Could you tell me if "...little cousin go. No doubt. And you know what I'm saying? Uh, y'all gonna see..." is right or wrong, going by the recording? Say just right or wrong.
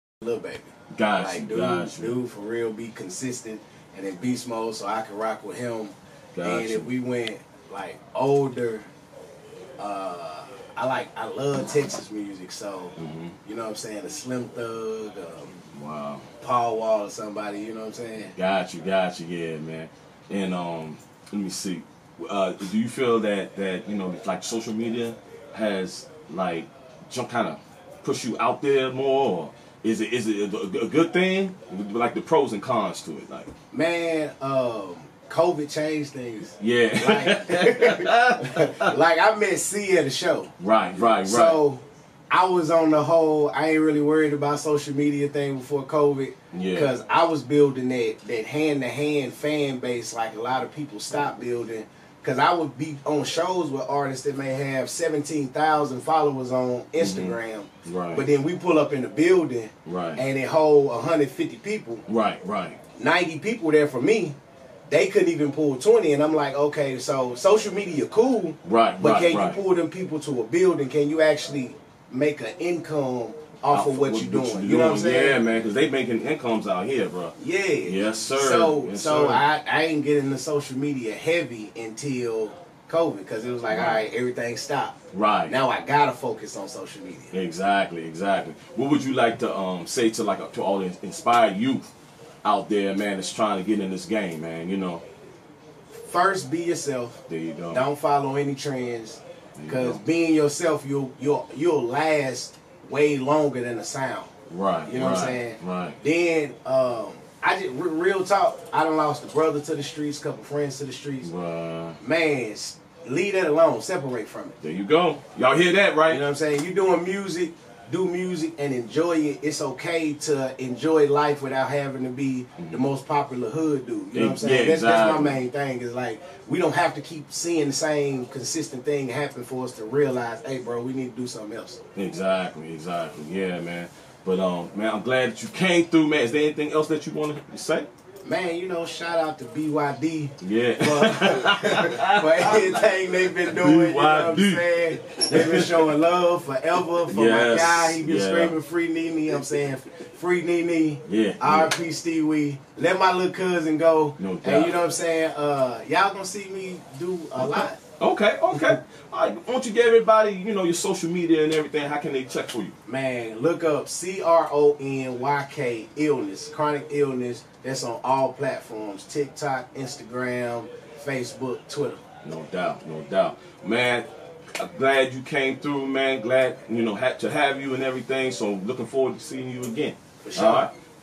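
right.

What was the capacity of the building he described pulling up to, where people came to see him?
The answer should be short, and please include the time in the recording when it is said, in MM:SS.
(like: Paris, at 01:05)
150, at 01:00.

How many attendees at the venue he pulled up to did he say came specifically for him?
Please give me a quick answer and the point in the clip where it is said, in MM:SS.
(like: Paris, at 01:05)
90, at 01:03.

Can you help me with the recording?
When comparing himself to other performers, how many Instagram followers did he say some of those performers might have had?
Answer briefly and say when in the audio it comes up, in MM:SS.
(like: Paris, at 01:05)
17,000, at 00:54.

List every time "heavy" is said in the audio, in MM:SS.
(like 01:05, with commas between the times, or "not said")
01:21.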